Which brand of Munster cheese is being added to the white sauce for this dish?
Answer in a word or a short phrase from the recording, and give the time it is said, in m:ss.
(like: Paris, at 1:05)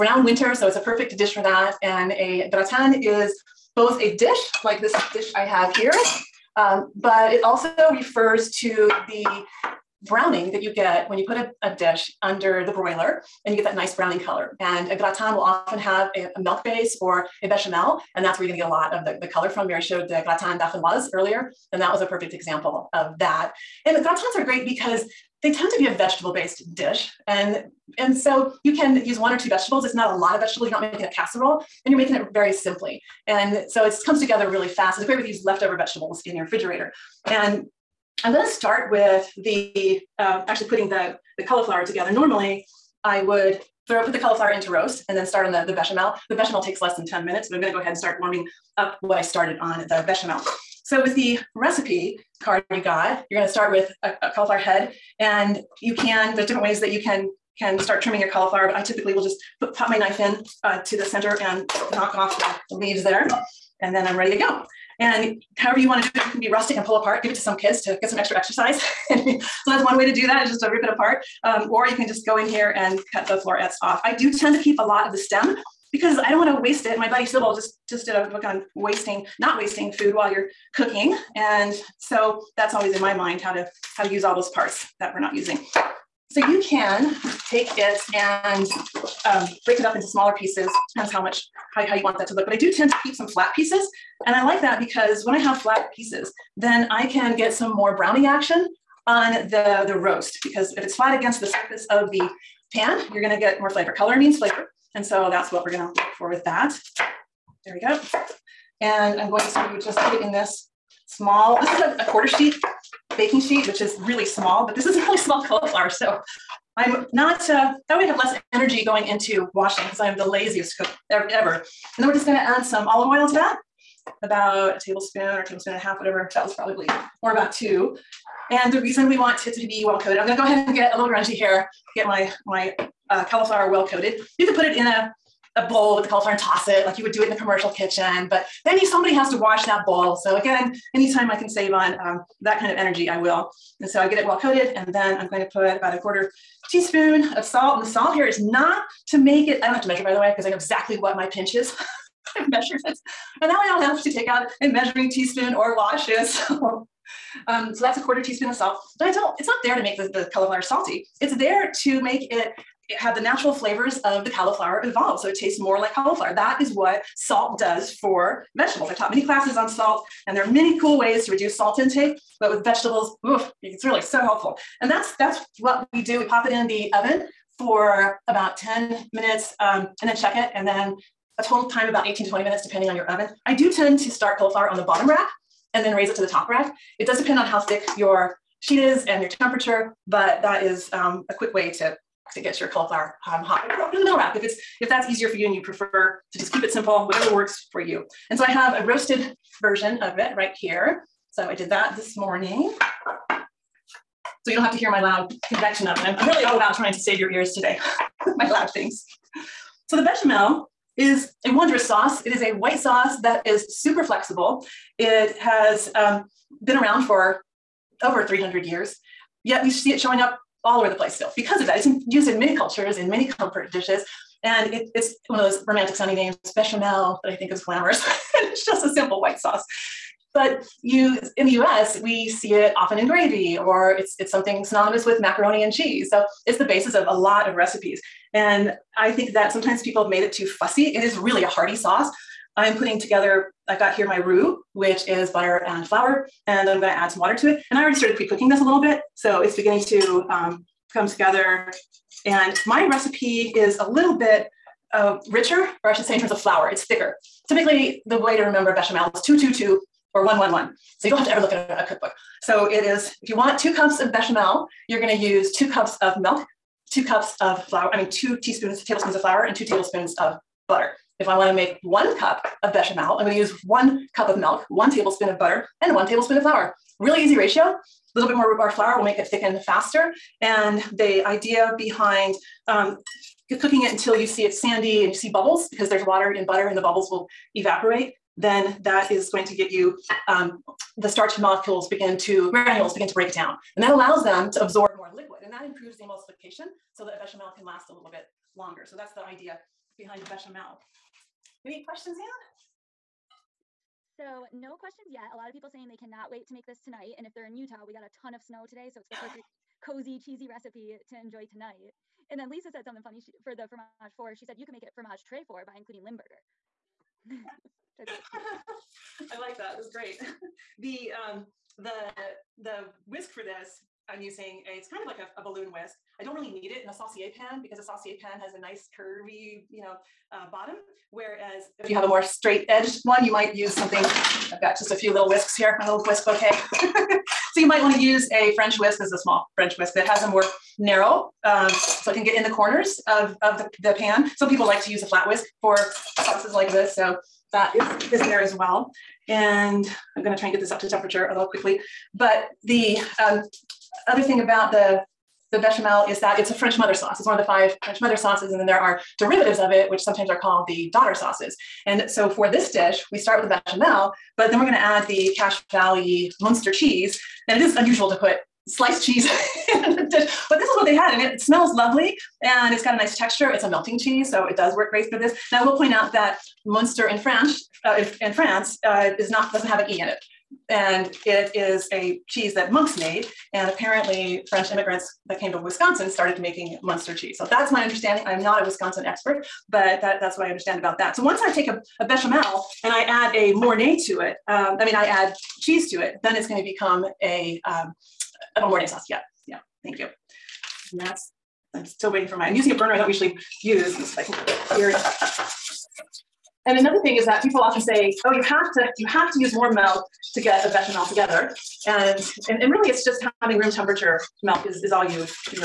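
Cache Valley, at 6:05.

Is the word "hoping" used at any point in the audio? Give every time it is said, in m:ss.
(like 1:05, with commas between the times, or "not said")
not said.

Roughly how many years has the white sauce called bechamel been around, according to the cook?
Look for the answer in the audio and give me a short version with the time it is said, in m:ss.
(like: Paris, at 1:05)
Over 300 years, at 3:38.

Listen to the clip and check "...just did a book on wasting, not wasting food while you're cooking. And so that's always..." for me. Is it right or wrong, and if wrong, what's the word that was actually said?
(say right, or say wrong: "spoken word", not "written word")
right.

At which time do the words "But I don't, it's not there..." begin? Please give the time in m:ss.
2:38.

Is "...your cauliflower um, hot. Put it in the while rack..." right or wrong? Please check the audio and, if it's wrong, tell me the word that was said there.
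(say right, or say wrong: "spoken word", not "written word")
wrong: "middle", not "while".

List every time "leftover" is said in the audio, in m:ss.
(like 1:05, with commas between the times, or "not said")
0:35.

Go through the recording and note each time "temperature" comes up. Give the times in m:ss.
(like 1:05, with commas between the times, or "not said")
3:09, 5:50, 6:53.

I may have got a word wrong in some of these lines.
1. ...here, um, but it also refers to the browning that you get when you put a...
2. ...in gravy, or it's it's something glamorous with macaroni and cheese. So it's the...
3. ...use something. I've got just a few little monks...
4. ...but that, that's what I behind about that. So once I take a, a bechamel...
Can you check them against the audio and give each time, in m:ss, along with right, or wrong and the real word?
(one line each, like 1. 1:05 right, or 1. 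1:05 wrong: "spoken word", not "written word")
1. 0:05 right
2. 3:52 wrong: "synonymous", not "glamorous"
3. 5:33 wrong: "whisks", not "monks"
4. 6:29 wrong: "understand", not "behind".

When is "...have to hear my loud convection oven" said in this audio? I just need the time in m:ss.
3:24.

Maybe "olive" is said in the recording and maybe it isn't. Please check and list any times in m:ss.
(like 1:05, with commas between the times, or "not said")
2:02.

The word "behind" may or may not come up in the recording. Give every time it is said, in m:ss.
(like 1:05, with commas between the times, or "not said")
4:41, 4:59.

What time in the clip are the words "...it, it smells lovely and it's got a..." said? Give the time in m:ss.
6:11.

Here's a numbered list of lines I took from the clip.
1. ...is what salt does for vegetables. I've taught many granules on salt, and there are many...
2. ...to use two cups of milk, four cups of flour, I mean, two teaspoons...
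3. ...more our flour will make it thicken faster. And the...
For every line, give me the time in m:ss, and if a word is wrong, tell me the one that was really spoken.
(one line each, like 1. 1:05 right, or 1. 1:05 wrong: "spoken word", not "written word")
1. 2:46 wrong: "classes", not "granules"
2. 4:25 wrong: "two", not "four"
3. 4:38 right.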